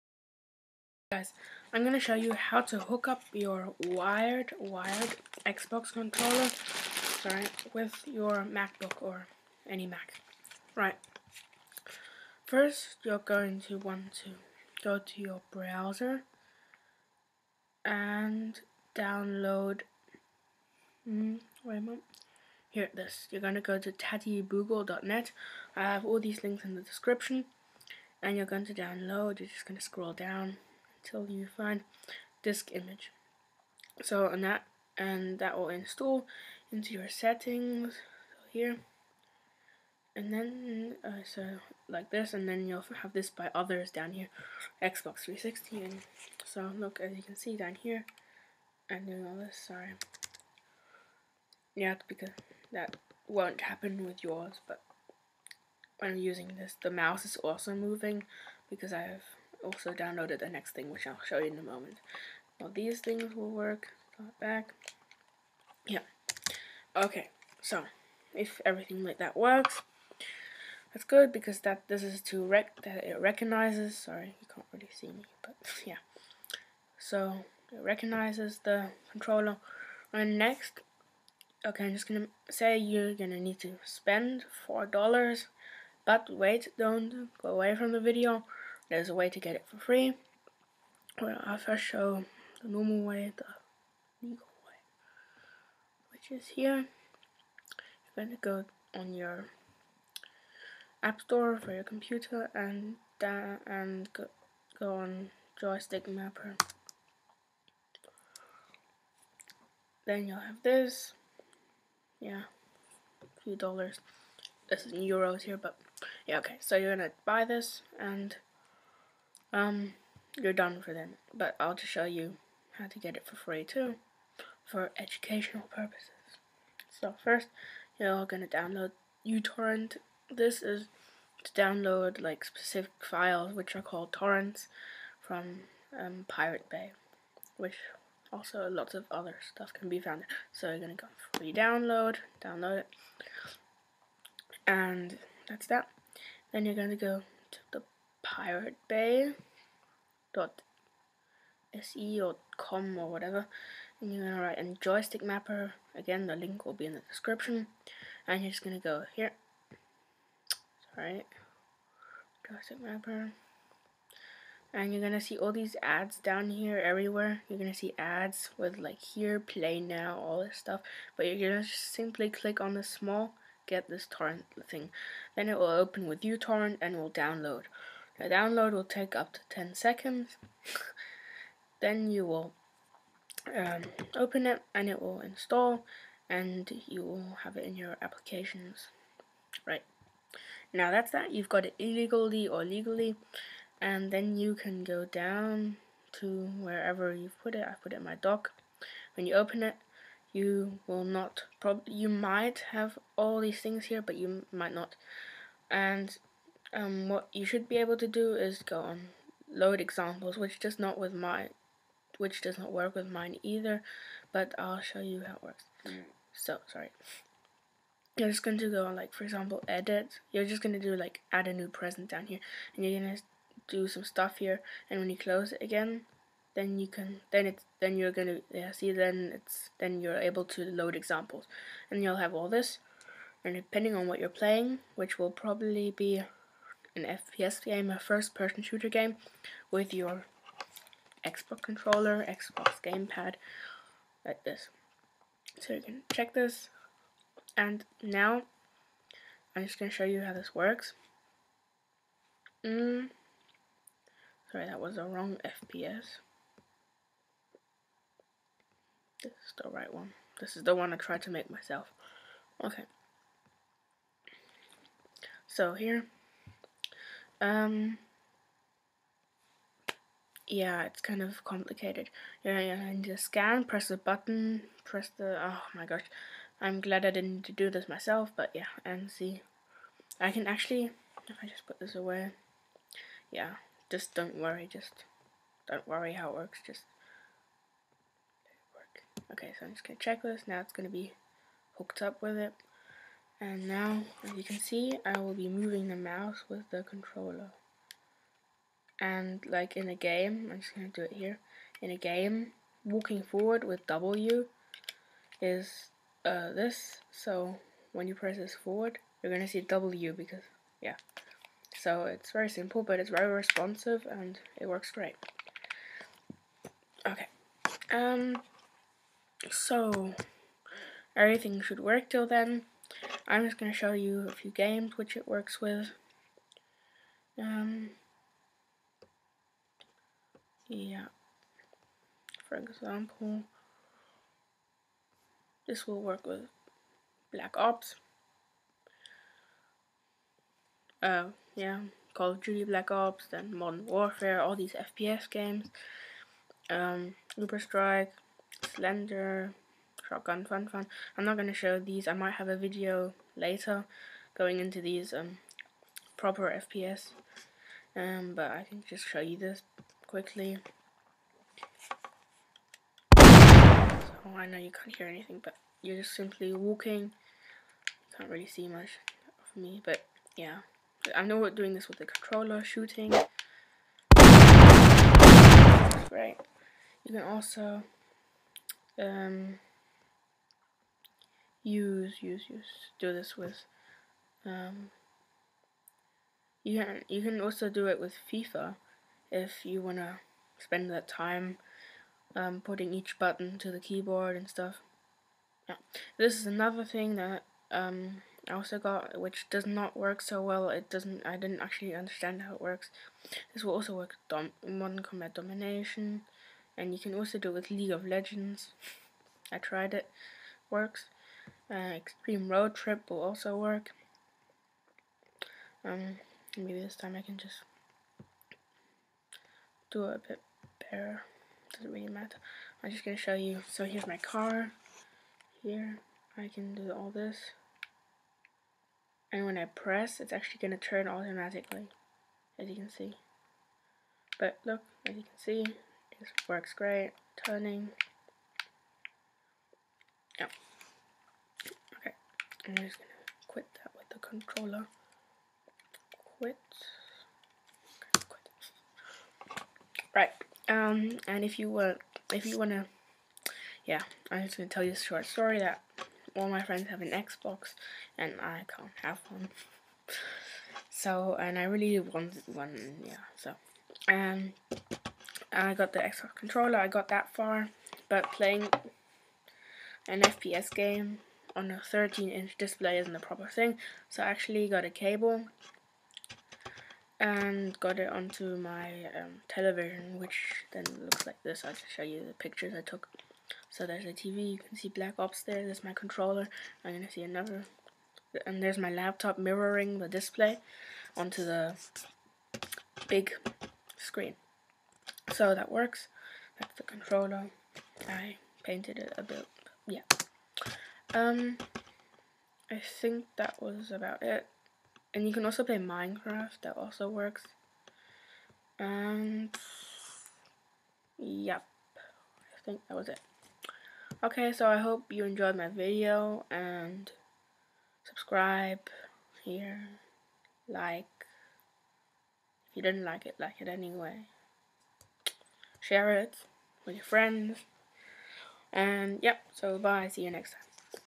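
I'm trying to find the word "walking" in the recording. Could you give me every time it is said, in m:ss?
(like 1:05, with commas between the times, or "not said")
5:02, 6:06.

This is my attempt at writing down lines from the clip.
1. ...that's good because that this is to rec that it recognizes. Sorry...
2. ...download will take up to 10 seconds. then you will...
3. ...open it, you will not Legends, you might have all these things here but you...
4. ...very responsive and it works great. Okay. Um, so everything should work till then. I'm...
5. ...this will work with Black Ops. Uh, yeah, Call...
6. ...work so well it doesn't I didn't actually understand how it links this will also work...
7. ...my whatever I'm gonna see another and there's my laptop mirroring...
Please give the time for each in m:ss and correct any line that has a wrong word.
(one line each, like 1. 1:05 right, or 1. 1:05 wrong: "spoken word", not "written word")
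1. 1:10 right
2. 2:58 right
3. 3:19 wrong: "Probably", not "Legends"
4. 5:13 right
5. 5:35 right
6. 6:39 wrong: "works", not "links"
7. 8:05 wrong: "controller", not "whatever".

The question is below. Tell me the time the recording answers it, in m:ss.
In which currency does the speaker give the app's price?
1:55.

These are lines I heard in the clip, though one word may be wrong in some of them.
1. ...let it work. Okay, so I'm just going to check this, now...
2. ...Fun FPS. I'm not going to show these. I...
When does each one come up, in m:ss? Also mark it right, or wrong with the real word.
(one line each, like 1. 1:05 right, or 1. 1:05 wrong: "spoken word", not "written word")
1. 4:48 right
2. 5:50 wrong: "Fun", not "FPS".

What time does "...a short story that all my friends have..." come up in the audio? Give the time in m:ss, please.
7:34.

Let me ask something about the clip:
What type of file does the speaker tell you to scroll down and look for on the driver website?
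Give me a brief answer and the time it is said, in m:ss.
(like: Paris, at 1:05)
Disk image, at 0:32.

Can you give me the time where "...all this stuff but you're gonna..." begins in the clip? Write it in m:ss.
2:50.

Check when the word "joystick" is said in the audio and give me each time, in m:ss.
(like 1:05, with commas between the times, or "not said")
1:45, 2:34, 2:42.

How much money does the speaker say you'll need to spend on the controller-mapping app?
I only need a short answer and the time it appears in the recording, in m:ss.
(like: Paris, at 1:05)
$4, at 1:24.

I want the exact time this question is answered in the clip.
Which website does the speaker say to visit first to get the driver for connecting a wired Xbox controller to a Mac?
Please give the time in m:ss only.
0:23.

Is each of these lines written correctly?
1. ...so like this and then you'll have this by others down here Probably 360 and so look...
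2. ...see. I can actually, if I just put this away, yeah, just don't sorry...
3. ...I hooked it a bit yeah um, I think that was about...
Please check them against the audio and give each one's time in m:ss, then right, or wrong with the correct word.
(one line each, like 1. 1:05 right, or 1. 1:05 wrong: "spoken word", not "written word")
1. 0:41 wrong: "Xbox", not "Probably"
2. 4:39 wrong: "worry", not "sorry"
3. 8:18 wrong: "painted", not "hooked".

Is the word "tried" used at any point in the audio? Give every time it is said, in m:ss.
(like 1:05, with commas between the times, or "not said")
4:20, 6:49.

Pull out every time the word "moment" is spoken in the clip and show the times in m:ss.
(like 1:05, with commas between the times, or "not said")
0:21, 1:01.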